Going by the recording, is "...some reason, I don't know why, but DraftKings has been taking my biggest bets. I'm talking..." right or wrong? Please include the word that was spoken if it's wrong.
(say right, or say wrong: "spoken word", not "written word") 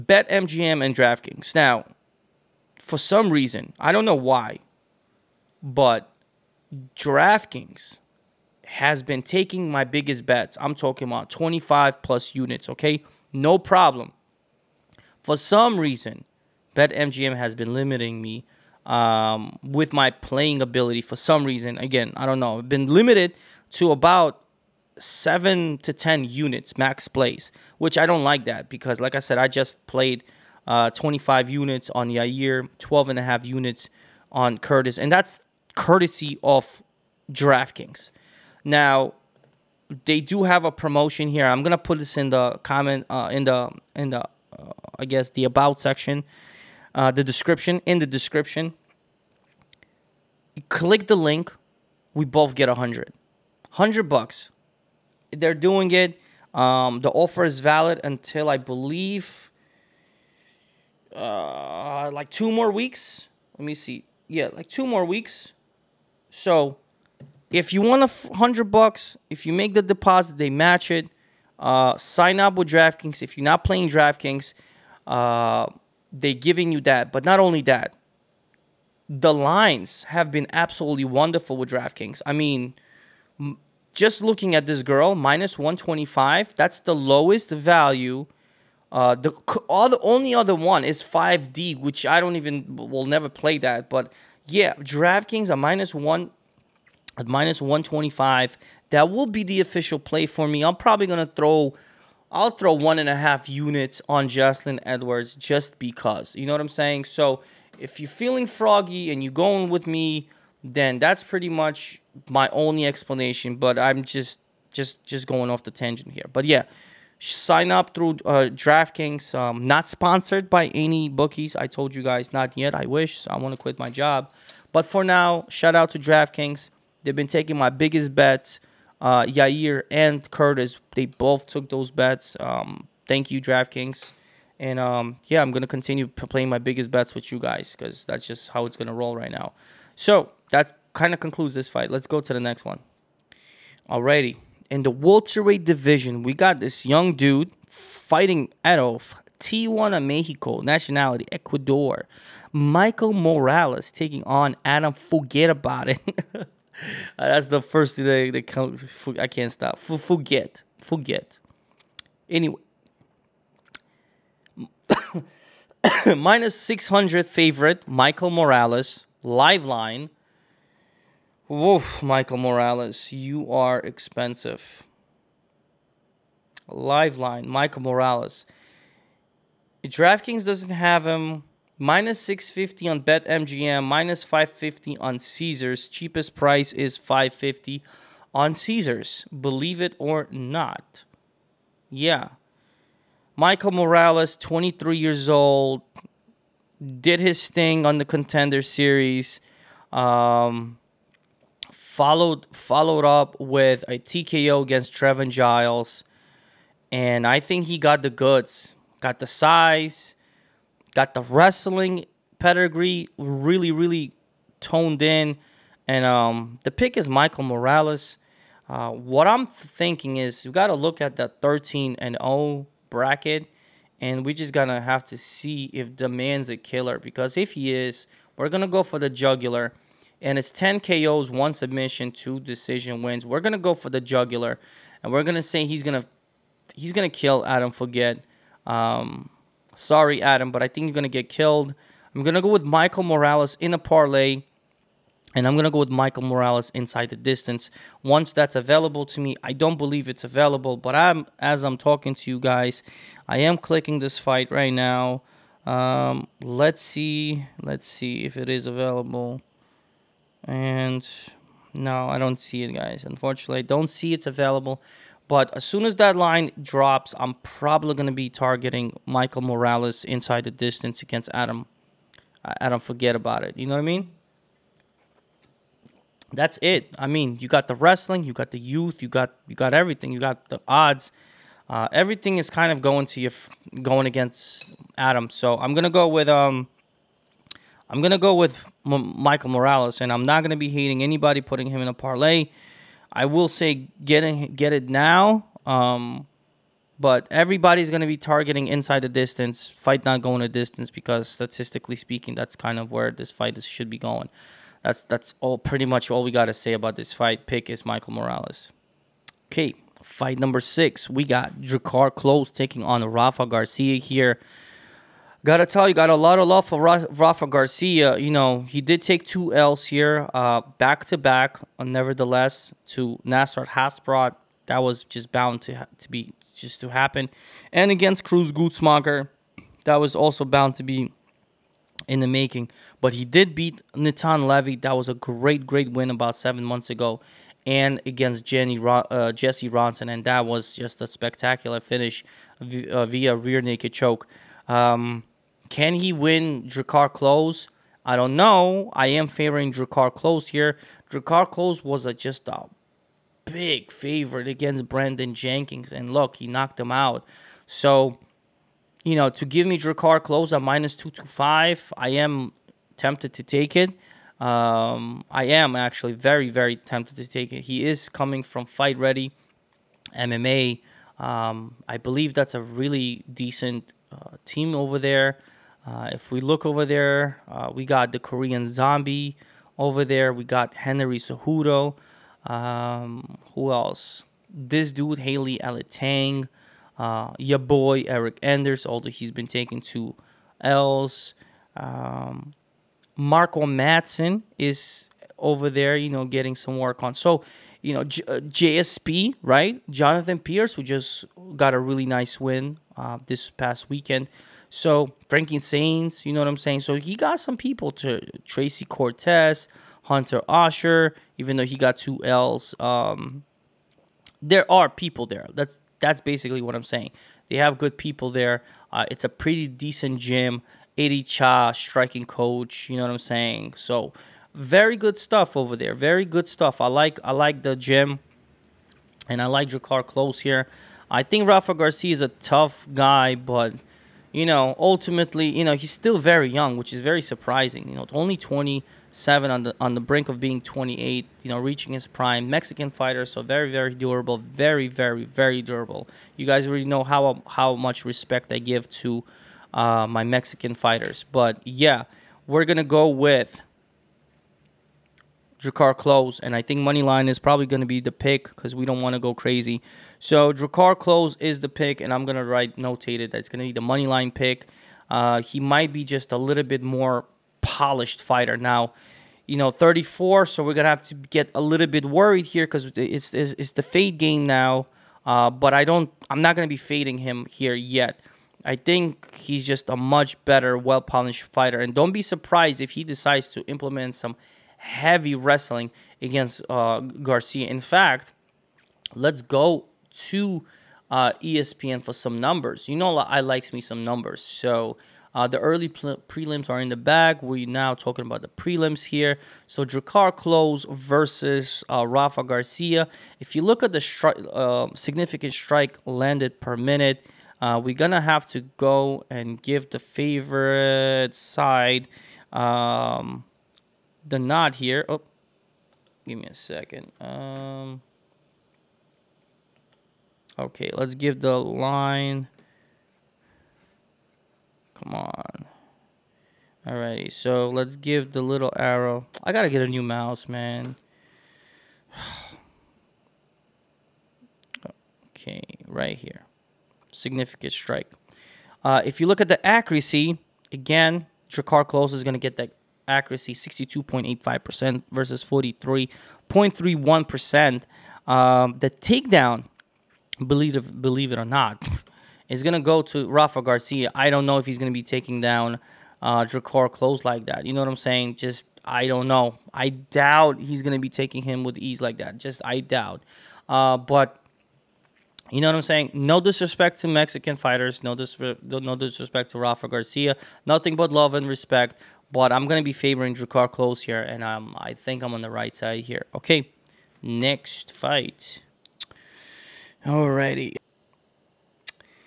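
right.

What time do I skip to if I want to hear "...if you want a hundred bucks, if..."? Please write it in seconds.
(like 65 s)
67 s.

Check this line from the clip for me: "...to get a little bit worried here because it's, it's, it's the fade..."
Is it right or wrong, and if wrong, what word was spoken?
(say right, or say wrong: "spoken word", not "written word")
right.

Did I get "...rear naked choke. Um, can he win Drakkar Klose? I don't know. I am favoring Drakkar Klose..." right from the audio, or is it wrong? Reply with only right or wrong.
right.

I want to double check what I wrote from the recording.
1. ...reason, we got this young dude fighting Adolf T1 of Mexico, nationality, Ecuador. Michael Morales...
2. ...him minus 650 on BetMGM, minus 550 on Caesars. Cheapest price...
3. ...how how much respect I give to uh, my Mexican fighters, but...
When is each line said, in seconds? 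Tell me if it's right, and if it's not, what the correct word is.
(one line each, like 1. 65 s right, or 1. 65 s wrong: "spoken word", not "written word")
1. 145 s wrong: "division", not "reason"
2. 181 s right
3. 447 s right.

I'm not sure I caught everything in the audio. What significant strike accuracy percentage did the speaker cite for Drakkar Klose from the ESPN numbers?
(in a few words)
62.85%.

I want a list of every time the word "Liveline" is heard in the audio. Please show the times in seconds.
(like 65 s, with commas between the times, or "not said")
169 s, 176 s.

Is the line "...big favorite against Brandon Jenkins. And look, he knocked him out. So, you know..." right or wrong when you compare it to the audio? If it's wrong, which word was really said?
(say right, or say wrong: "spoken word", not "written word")
right.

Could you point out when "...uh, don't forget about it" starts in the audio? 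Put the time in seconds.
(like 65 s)
272 s.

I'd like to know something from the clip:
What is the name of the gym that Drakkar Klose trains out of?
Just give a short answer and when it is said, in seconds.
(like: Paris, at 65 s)
Fight Ready MMA, at 368 s.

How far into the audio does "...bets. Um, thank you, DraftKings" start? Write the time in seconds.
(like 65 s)
131 s.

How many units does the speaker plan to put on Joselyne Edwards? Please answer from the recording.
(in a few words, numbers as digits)
1.5.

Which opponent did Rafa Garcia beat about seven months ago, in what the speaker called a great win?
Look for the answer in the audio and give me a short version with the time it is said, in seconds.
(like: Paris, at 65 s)
Nathan Levy, at 333 s.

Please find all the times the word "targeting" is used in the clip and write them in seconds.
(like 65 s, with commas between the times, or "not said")
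268 s, 298 s.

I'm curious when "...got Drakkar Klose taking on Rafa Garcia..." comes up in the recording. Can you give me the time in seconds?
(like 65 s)
311 s.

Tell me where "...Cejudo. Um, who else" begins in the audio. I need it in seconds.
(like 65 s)
381 s.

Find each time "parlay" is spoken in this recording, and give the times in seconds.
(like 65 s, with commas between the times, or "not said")
243 s, 291 s.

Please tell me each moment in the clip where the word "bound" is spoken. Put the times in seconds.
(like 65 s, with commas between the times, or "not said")
325 s, 330 s.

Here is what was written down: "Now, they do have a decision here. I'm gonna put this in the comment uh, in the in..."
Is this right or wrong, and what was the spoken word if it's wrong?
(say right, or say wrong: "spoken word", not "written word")
wrong: "promotion", not "decision".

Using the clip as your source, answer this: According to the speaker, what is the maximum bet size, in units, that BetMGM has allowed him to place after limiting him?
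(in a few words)
7 to 10 units.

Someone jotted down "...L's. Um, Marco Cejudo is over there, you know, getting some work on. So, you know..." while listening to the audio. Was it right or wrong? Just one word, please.
wrong.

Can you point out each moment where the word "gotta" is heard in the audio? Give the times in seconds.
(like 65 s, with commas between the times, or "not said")
315 s, 529 s.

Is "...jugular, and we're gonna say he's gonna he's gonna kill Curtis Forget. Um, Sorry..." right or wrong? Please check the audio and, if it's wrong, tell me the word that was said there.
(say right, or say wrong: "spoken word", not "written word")
wrong: "Adam", not "Curtis".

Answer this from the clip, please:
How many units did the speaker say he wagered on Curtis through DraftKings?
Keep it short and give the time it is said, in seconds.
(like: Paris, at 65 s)
12.5, at 32 s.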